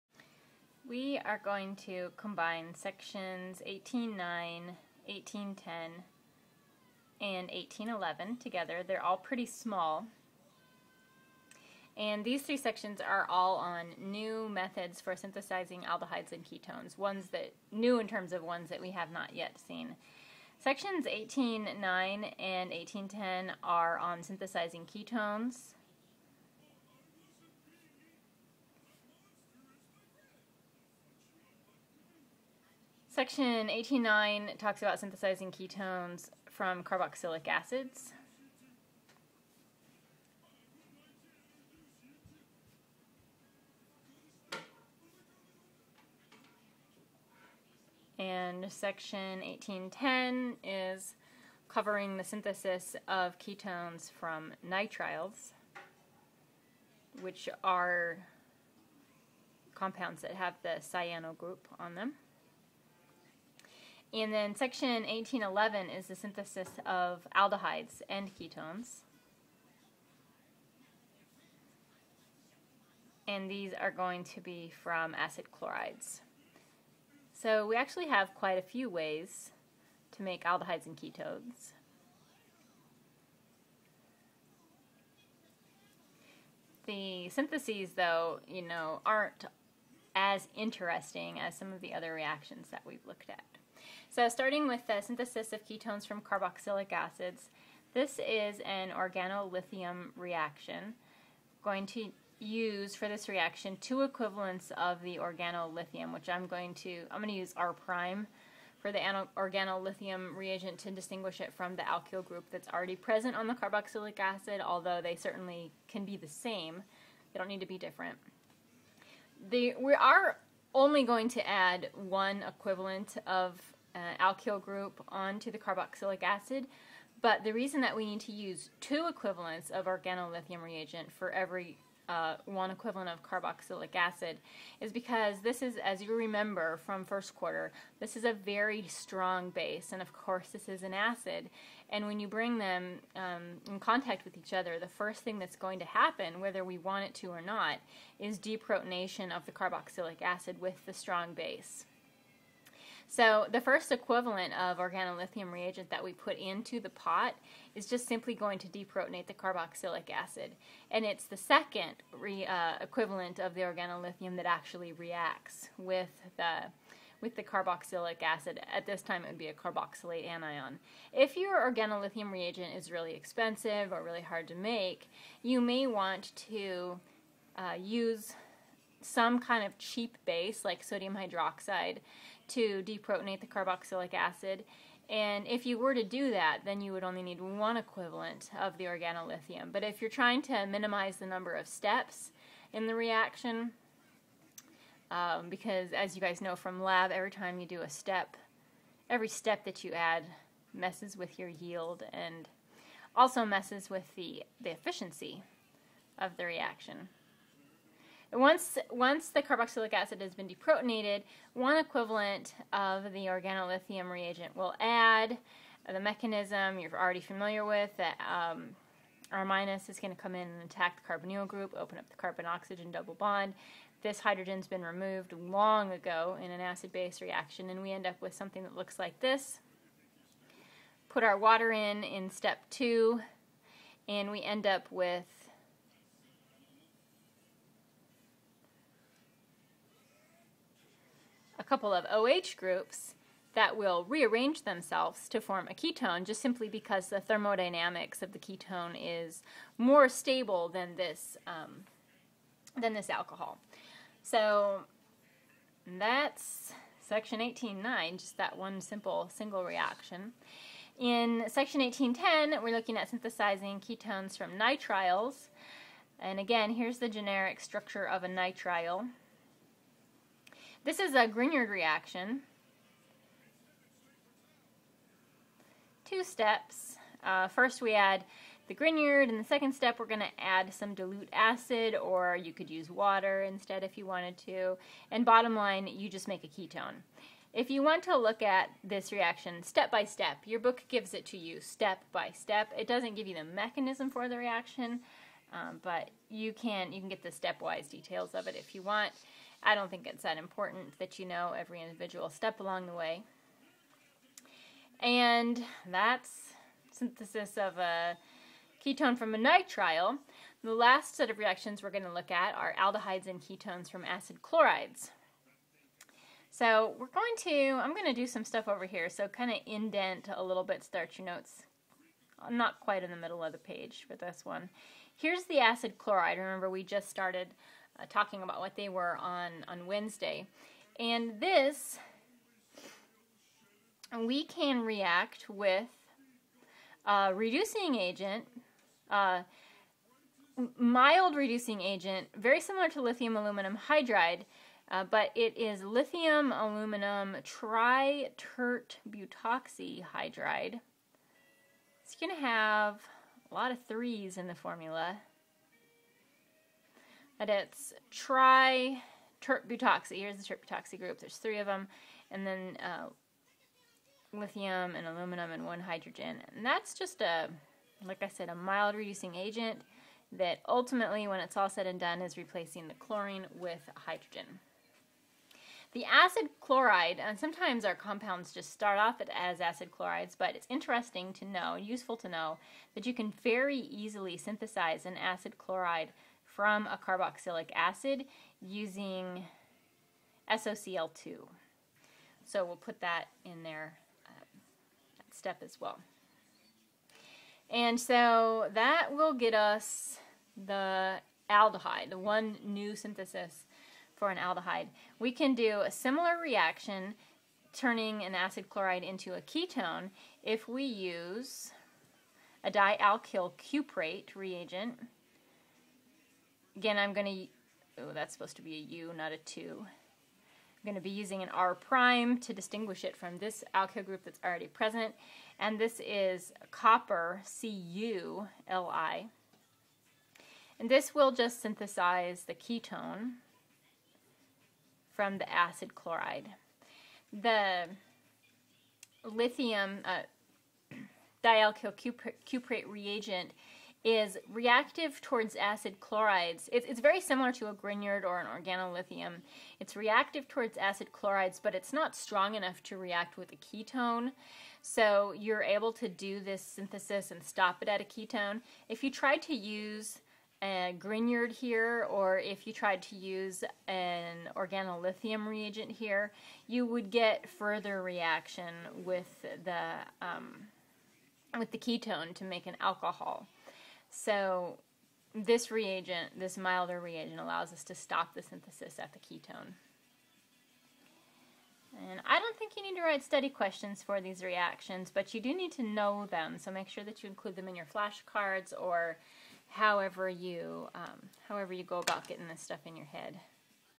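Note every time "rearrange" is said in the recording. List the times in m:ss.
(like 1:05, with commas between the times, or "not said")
4:04.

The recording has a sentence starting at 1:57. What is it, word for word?
They don't need to be different.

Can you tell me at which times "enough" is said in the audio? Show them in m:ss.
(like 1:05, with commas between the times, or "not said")
7:32.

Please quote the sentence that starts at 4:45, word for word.
And bottom line, you just make a ketone.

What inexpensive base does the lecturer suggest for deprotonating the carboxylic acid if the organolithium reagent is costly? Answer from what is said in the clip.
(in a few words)
sodium hydroxide.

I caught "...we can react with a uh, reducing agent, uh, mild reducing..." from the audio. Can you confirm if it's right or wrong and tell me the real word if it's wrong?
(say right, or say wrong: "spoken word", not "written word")
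right.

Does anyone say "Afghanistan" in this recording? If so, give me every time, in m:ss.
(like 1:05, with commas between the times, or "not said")
not said.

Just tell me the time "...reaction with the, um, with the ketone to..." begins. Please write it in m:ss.
7:48.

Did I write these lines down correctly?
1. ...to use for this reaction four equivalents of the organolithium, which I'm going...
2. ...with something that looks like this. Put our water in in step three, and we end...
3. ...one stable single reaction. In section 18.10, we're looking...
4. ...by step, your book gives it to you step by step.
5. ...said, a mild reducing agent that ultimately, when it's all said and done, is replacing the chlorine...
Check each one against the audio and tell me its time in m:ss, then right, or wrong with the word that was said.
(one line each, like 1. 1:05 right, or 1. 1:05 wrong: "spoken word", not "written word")
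1. 1:41 wrong: "two", not "four"
2. 3:48 wrong: "two", not "three"
3. 4:18 wrong: "simple", not "stable"
4. 4:49 right
5. 6:08 right.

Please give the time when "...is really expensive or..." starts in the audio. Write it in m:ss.
2:52.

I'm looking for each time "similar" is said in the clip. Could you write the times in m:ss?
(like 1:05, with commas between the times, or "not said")
5:42, 6:45, 7:27.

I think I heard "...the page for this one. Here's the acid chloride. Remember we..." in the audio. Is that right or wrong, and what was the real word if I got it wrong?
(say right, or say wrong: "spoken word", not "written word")
right.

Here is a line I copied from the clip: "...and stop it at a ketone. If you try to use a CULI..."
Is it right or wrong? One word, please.
wrong.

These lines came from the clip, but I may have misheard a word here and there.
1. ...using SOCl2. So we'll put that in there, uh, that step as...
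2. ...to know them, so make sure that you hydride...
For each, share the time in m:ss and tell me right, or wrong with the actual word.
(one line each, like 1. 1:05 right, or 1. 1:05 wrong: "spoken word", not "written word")
1. 6:28 right
2. 8:05 wrong: "include", not "hydride".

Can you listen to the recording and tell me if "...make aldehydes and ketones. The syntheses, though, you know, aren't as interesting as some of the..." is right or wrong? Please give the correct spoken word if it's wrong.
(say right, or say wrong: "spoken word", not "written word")
right.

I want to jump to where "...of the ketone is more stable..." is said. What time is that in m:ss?
4:08.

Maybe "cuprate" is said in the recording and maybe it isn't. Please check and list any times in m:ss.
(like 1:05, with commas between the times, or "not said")
6:53, 7:22.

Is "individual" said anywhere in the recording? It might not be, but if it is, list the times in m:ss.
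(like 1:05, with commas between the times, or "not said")
5:01.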